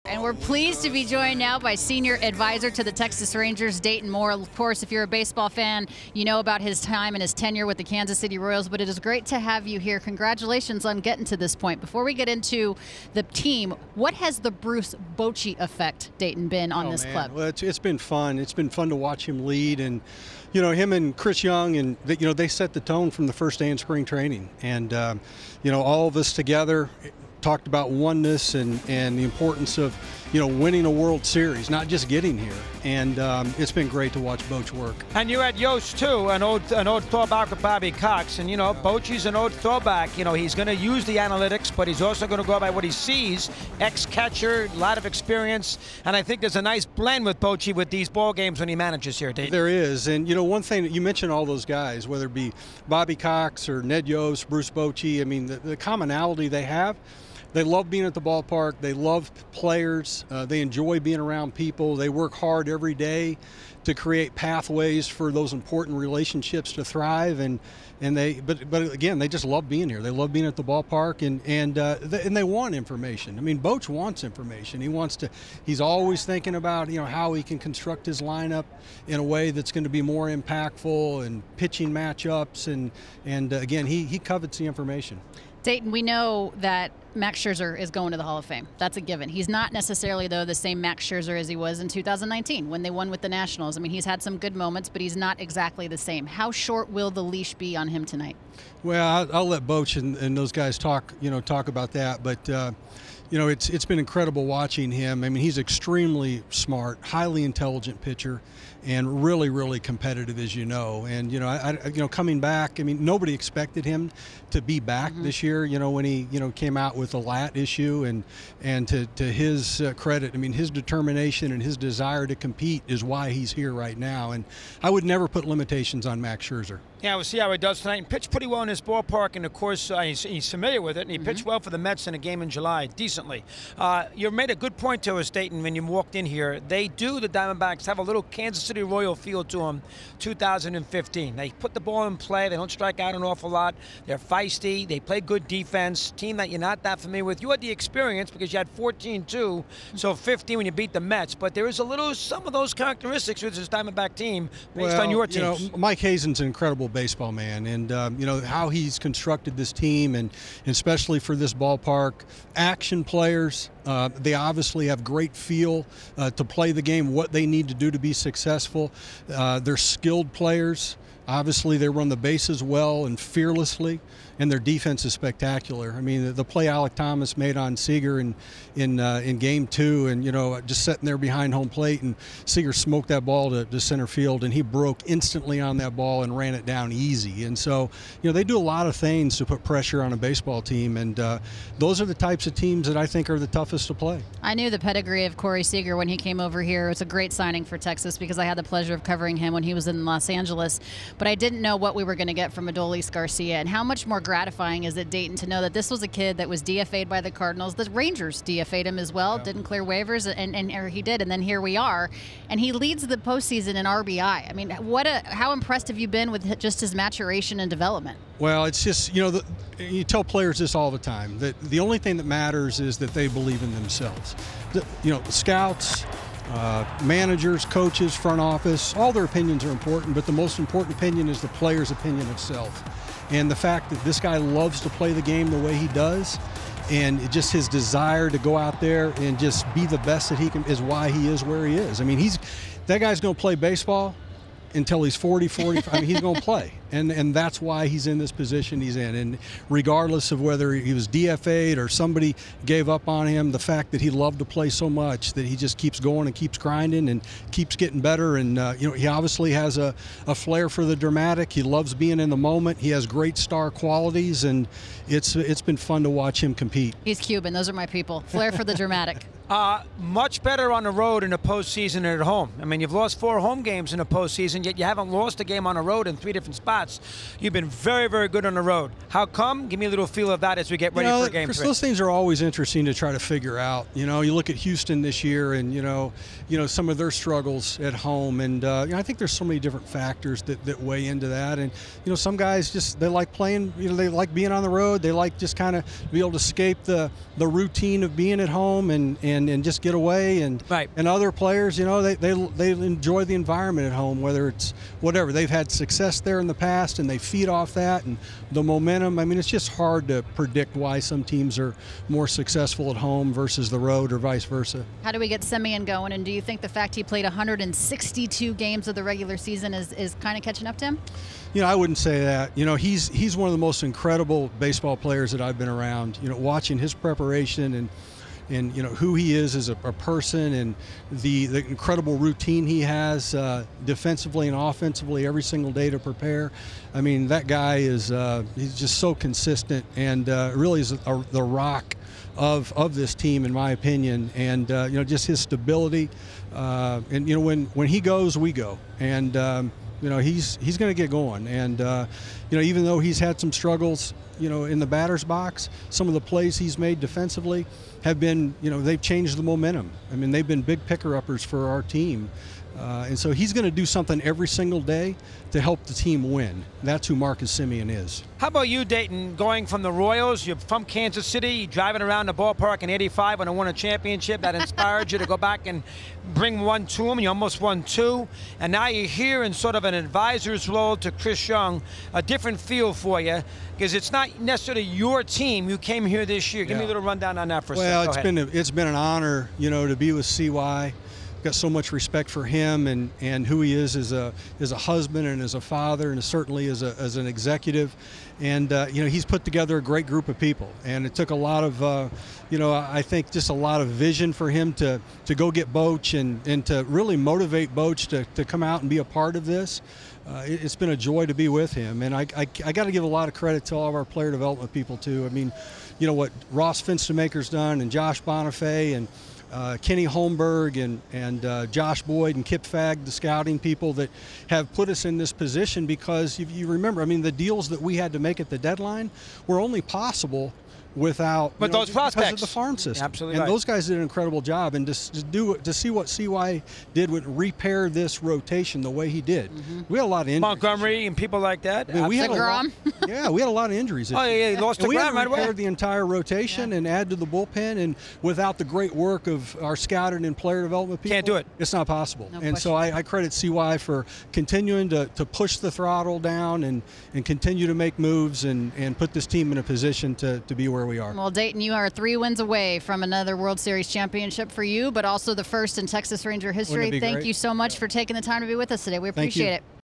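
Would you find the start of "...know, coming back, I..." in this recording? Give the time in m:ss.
1:52.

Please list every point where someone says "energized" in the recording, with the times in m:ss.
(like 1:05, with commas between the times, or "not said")
not said.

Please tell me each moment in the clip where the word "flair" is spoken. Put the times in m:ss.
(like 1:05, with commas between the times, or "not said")
4:20, 4:28.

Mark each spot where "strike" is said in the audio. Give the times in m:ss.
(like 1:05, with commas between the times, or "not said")
2:22.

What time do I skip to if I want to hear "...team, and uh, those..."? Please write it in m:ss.
3:10.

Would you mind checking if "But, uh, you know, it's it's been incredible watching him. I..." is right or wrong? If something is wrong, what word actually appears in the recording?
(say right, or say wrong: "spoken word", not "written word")
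right.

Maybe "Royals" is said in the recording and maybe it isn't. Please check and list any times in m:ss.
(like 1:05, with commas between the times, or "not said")
0:08, 2:18, 6:09.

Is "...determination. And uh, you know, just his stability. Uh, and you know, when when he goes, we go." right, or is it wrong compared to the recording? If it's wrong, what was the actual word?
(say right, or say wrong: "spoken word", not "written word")
wrong: "opinion", not "determination".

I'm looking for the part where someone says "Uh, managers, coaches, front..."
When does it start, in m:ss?
3:46.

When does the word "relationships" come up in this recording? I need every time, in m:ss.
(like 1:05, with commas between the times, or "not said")
1:05.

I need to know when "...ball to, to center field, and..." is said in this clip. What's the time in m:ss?
3:03.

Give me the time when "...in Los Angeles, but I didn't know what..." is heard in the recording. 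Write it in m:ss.
3:19.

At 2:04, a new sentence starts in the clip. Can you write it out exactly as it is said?
And I would never put limitations on Max Scherzer.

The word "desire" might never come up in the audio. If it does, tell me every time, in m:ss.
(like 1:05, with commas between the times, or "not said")
2:01, 3:57.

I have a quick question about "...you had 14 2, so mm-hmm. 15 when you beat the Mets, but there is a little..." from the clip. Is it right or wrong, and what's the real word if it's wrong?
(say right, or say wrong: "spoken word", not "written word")
right.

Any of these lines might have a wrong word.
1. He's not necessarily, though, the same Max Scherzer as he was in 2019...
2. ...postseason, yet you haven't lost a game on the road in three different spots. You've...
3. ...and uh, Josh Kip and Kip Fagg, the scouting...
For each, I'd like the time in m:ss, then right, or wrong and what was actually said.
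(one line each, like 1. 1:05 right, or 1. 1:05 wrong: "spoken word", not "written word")
1. 1:29 right
2. 4:34 right
3. 7:01 wrong: "Boyd", not "Kip".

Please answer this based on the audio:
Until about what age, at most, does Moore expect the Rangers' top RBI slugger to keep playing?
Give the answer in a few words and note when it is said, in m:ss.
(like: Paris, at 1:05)
45, at 4:05.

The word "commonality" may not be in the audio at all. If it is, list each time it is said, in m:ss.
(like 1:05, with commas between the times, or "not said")
0:55.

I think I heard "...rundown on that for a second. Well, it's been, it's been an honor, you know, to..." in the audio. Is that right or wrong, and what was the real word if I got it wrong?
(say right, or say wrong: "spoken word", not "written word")
right.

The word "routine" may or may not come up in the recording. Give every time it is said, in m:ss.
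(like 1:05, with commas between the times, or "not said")
4:57, 5:32.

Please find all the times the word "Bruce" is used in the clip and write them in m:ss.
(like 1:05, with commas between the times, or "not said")
0:14, 0:54.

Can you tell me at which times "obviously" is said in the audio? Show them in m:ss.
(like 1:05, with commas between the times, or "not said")
2:44, 2:51, 4:19.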